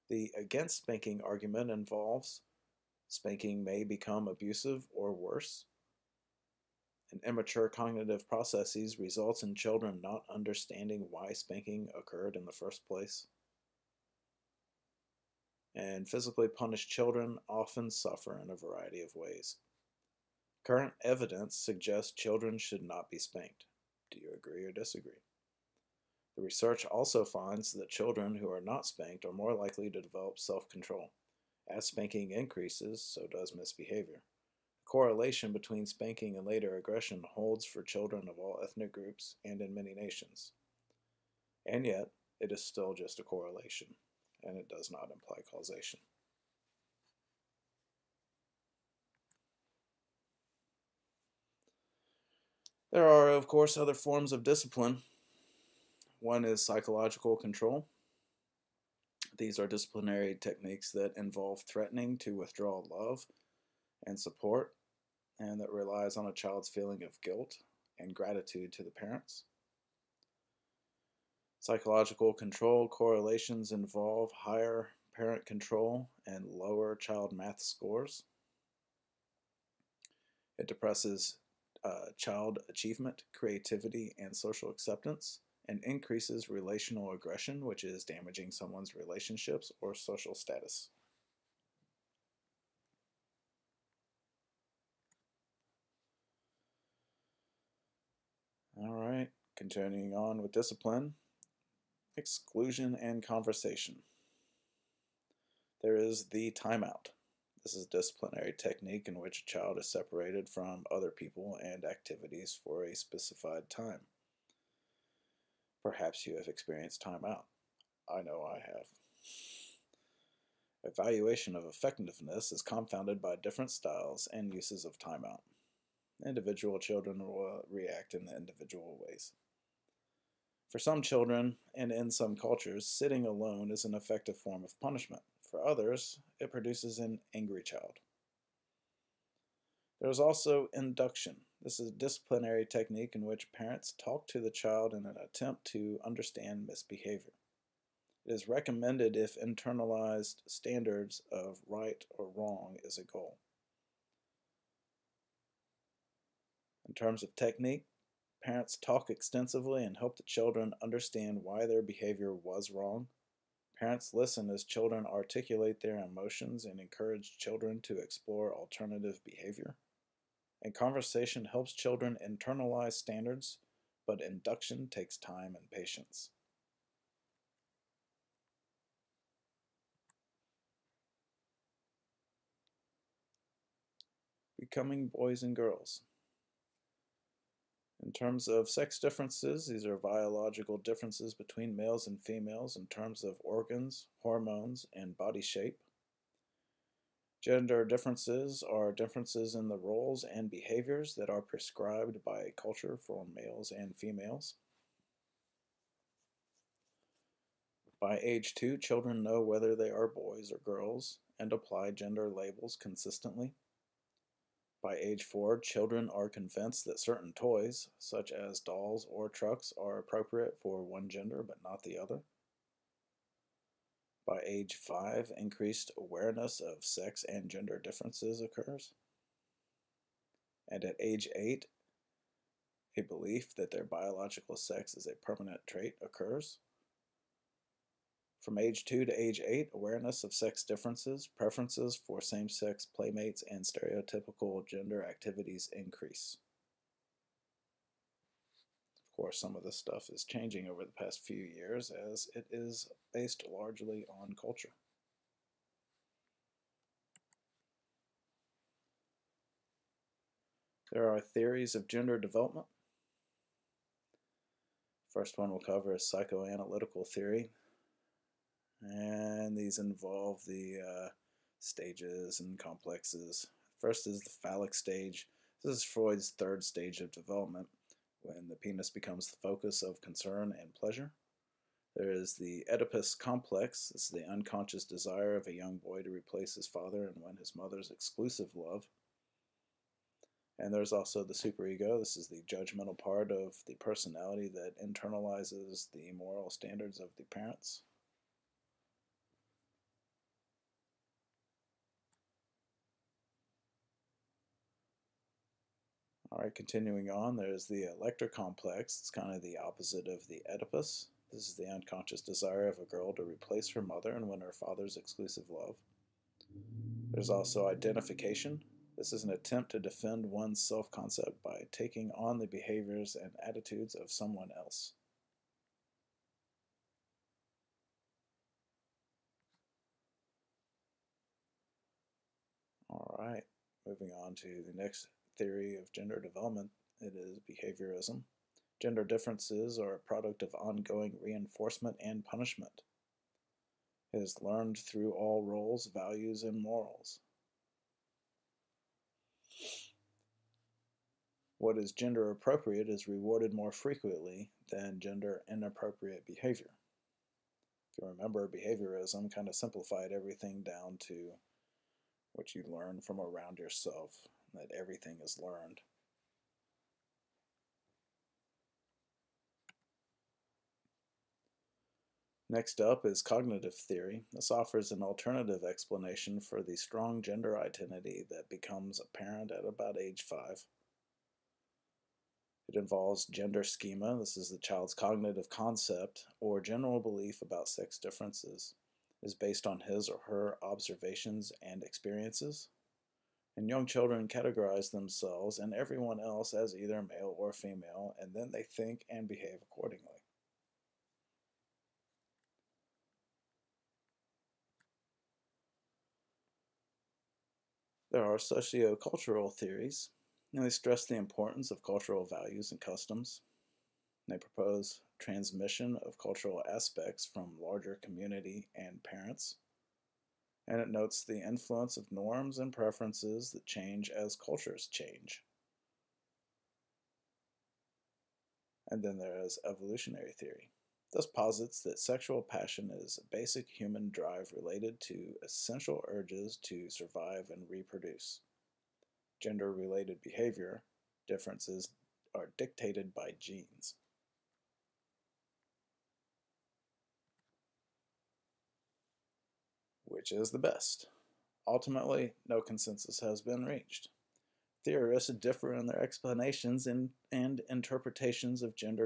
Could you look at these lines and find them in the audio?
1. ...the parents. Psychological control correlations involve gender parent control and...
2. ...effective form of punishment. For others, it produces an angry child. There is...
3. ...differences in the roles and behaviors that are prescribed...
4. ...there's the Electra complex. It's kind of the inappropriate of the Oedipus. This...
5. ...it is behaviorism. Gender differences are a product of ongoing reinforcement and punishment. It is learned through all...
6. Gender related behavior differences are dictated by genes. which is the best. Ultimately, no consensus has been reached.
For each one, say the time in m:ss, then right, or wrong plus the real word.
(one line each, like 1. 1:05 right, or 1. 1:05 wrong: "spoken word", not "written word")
1. 1:08 wrong: "higher", not "gender"
2. 2:13 right
3. 3:18 right
4. 5:07 wrong: "opposite", not "inappropriate"
5. 5:37 right
6. 7:19 right.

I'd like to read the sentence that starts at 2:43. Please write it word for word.
Parents listen as children articulate their emotions and encourage children to explore alternative behavior.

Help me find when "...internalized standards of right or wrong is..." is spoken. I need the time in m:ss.
2:29.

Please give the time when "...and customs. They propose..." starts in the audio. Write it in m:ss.
6:52.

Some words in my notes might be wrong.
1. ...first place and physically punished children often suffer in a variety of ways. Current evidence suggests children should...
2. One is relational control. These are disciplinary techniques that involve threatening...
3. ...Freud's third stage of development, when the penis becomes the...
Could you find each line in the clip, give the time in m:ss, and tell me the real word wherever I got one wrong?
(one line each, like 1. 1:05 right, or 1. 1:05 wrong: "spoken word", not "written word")
1. 0:12 right
2. 0:56 wrong: "psychological", not "relational"
3. 4:35 right.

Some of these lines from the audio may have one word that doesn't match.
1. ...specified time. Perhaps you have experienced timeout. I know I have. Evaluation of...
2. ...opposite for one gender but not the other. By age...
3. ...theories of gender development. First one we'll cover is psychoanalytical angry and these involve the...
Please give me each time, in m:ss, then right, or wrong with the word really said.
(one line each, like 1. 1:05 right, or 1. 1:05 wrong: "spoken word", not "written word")
1. 1:52 right
2. 3:39 wrong: "appropriate", not "opposite"
3. 4:21 wrong: "theory", not "angry".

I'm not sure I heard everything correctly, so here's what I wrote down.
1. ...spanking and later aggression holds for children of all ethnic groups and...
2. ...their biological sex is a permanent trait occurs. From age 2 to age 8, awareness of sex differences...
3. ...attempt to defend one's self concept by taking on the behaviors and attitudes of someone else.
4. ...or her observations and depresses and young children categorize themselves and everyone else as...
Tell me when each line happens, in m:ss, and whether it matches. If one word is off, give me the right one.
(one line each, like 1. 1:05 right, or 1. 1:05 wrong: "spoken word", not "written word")
1. 0:35 right
2. 3:53 right
3. 5:19 right
4. 6:30 wrong: "experiences", not "depresses".